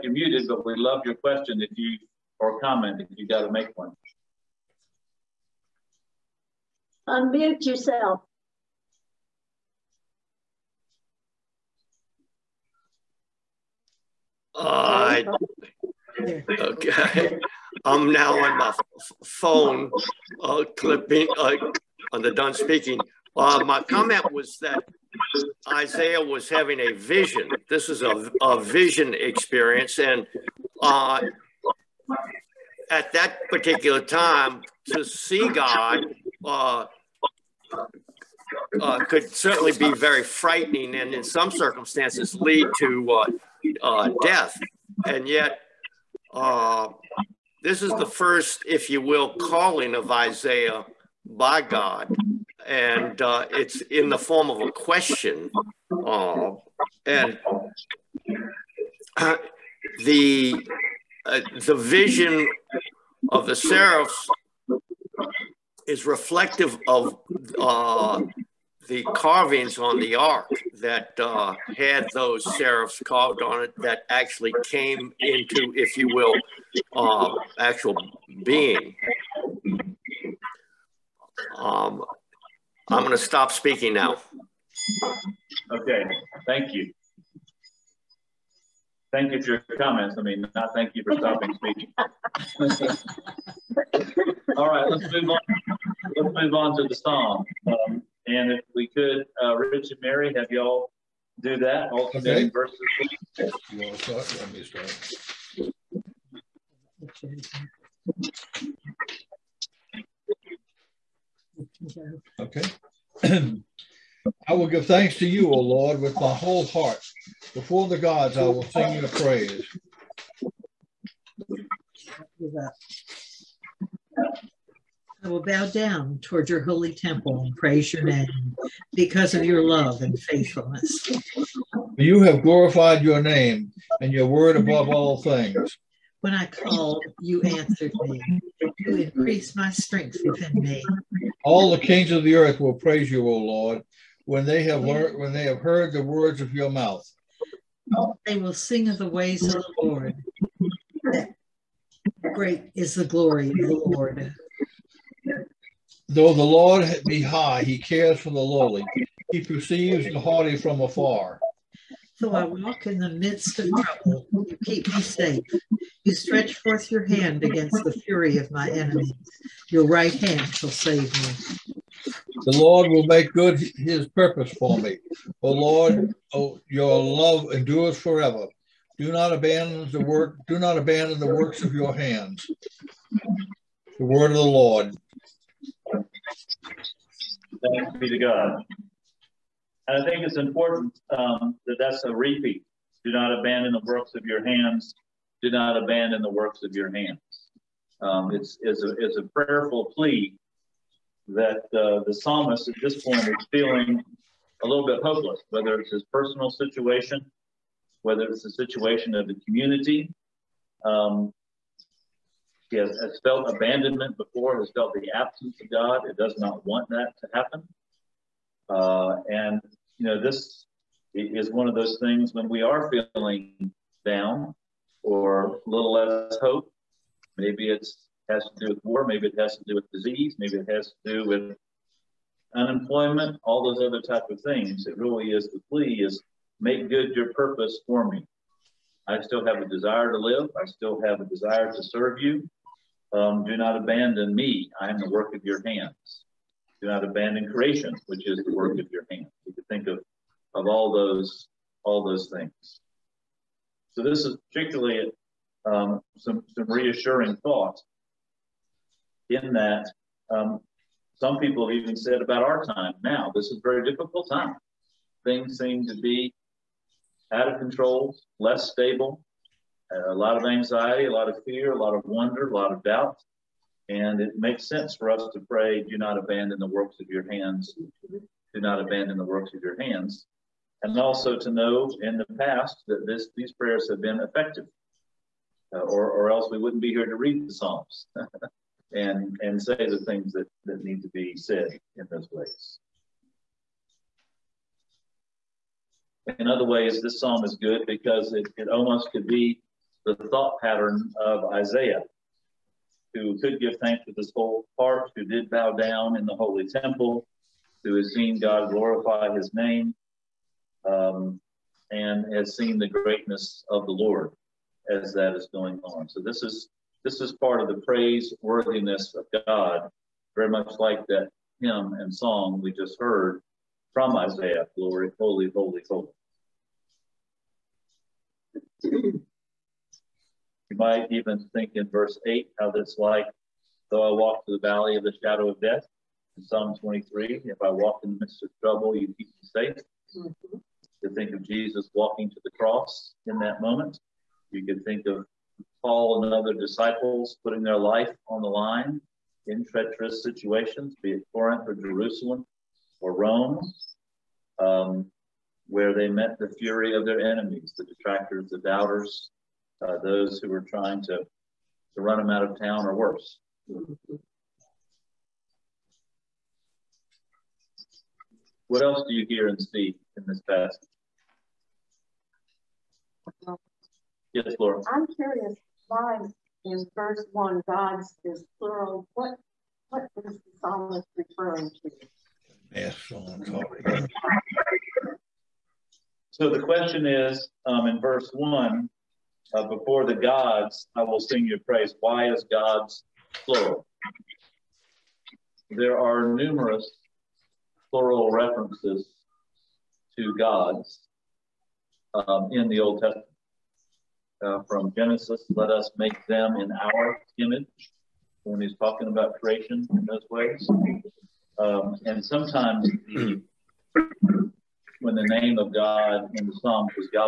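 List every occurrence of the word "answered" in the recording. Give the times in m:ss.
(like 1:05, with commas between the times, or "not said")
2:17.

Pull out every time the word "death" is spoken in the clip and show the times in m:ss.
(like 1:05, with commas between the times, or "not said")
0:44, 5:35.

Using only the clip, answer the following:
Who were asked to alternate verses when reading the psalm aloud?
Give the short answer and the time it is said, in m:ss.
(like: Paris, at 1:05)
Rich and Mary, at 1:39.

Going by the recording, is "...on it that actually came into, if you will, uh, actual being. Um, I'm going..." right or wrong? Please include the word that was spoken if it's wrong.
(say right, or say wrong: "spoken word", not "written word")
right.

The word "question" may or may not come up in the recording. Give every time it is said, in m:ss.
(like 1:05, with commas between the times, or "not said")
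0:01, 0:54, 6:26.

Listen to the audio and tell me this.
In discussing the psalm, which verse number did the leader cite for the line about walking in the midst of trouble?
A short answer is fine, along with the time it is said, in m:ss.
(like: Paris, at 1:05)
8, at 5:31.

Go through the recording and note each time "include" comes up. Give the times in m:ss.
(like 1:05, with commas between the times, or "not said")
not said.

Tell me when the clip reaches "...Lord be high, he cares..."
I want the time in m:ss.
2:36.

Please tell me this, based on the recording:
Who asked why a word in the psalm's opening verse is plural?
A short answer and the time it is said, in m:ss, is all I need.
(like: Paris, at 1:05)
Laura, at 6:14.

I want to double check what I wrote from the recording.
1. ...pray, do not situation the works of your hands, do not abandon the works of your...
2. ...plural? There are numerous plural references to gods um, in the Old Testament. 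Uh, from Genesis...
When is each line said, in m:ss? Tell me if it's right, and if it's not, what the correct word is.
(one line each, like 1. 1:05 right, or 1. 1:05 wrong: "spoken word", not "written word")
1. 4:35 wrong: "abandon", not "situation"
2. 6:33 right.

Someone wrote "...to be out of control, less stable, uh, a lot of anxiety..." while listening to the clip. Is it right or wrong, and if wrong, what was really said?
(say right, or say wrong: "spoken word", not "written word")
right.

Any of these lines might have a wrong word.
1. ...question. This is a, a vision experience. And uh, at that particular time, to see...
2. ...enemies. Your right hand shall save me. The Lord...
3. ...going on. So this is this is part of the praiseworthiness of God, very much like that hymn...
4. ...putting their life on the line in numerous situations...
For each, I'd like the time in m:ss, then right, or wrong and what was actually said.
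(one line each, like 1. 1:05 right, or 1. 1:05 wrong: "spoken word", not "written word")
1. 0:26 wrong: "vision", not "question"
2. 2:48 right
3. 5:15 right
4. 5:47 wrong: "treacherous", not "numerous".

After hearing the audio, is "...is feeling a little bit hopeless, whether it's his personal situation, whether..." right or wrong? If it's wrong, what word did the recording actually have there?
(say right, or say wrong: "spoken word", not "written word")
right.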